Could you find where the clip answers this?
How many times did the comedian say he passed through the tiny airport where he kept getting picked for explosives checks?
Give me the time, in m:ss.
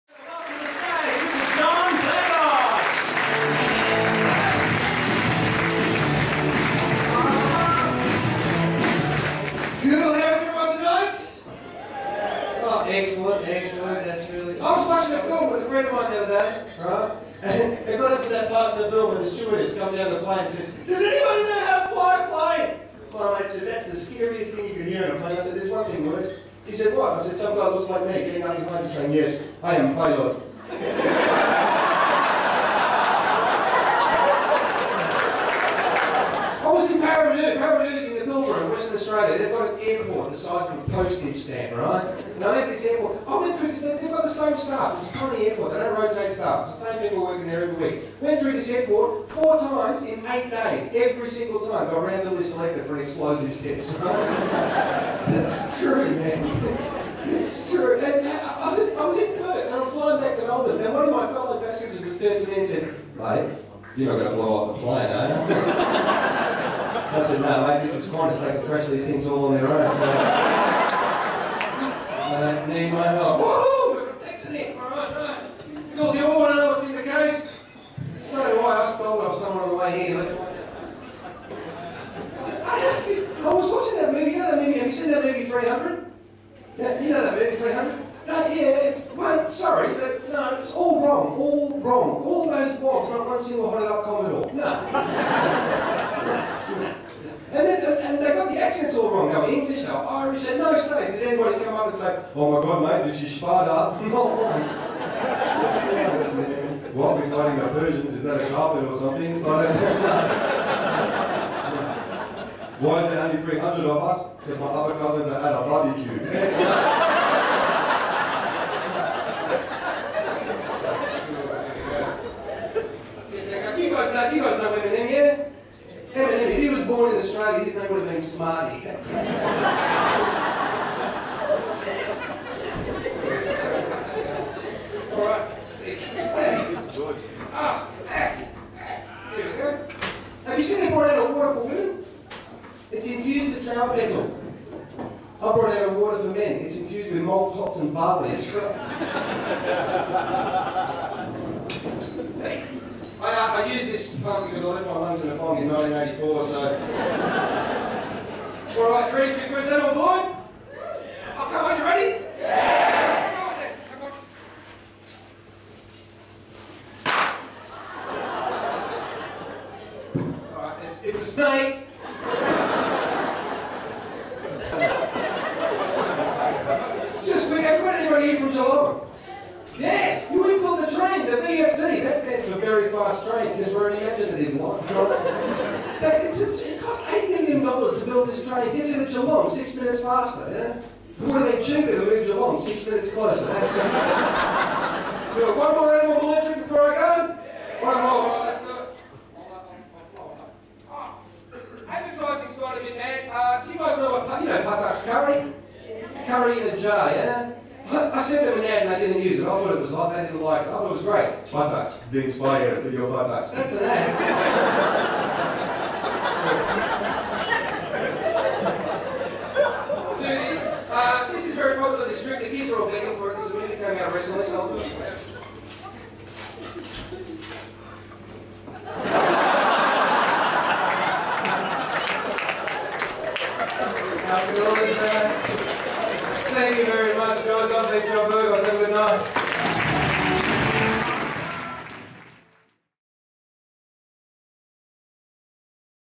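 0:49.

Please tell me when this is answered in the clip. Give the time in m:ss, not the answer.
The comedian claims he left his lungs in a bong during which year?
2:35.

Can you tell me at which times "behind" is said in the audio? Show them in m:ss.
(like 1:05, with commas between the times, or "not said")
0:28.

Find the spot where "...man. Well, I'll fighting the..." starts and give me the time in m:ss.
1:46.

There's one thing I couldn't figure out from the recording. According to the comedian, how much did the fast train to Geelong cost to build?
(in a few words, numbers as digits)
$8 million.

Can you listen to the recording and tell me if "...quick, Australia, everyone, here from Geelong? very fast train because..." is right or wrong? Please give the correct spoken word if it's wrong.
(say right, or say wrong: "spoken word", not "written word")
wrong: "Everyone", not "Australia".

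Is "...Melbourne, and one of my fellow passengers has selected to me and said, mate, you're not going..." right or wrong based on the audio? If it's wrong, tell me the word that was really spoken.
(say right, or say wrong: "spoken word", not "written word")
wrong: "turned", not "selected".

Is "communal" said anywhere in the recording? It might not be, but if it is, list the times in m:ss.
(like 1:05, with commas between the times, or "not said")
not said.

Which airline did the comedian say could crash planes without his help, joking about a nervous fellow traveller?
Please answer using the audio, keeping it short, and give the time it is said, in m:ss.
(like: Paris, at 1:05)
Qantas, at 1:08.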